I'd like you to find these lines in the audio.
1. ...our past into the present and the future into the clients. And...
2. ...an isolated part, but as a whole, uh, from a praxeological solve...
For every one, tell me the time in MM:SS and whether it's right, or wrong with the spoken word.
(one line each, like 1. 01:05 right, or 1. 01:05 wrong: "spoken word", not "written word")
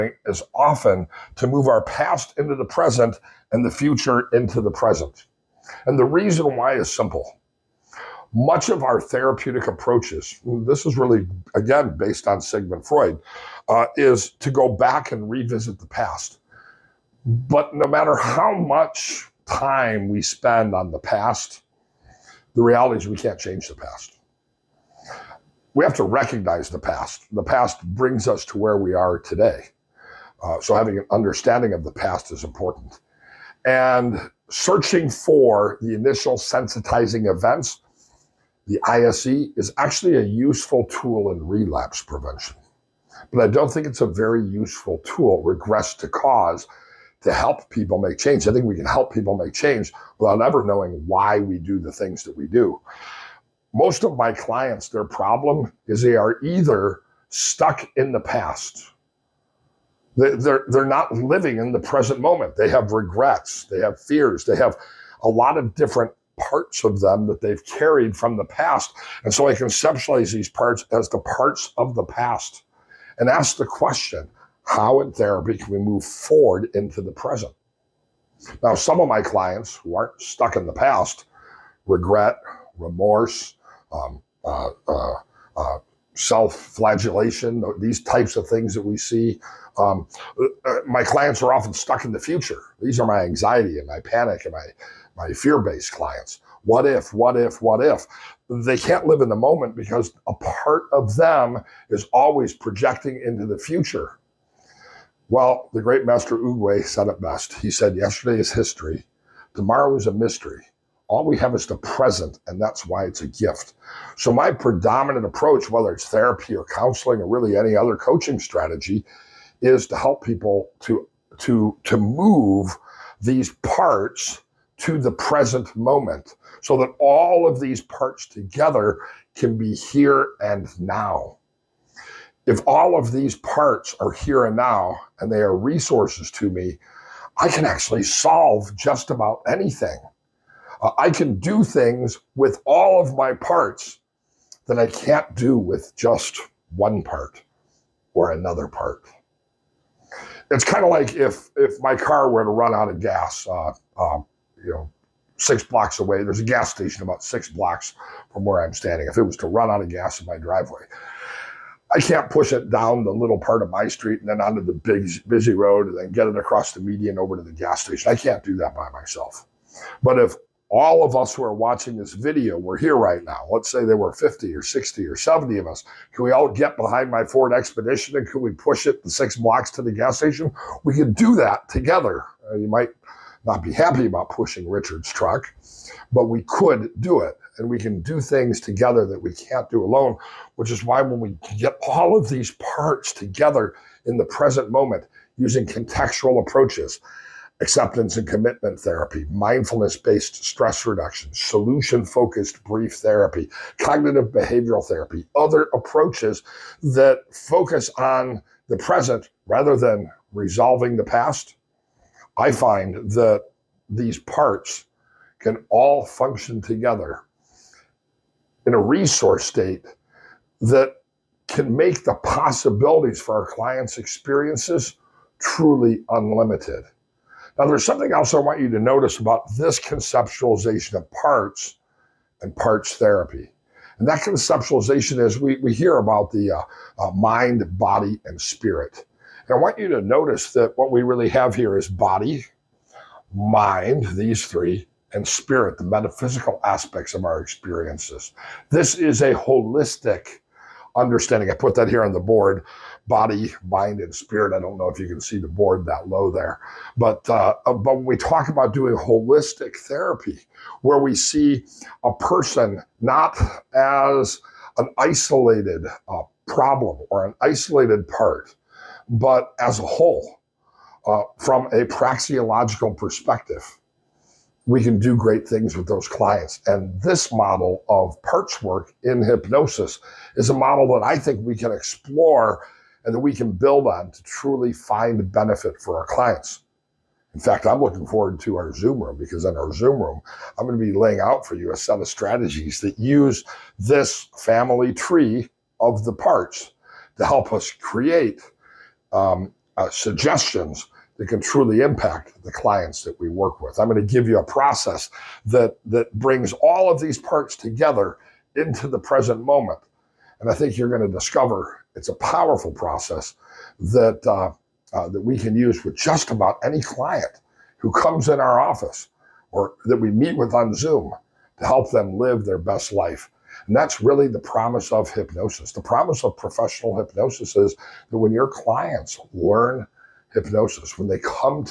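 1. 00:01 wrong: "present", not "clients"
2. 04:27 wrong: "perspective", not "solve".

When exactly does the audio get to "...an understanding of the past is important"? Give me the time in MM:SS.
00:30.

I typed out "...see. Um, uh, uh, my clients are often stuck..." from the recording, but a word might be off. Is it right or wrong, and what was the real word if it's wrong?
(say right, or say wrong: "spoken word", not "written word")
right.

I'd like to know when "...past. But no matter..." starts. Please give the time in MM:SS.
00:15.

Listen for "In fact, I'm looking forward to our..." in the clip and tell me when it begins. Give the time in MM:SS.
04:47.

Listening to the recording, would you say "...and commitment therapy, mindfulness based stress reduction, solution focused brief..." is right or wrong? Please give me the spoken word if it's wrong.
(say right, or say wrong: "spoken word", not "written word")
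right.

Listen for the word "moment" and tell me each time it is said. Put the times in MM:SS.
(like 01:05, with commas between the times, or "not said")
01:02, 01:39, 02:05, 03:14, 05:09.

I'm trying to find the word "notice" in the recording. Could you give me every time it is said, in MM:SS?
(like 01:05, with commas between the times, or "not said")
03:48, 04:00.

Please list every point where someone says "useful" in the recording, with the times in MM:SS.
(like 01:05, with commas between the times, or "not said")
00:40, 00:44.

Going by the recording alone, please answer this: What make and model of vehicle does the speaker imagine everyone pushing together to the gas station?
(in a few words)
Ford Expedition.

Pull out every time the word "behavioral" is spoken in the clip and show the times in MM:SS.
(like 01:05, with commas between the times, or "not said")
03:24.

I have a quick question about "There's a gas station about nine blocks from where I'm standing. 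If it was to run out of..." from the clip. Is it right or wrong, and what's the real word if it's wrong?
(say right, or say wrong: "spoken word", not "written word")
wrong: "six", not "nine".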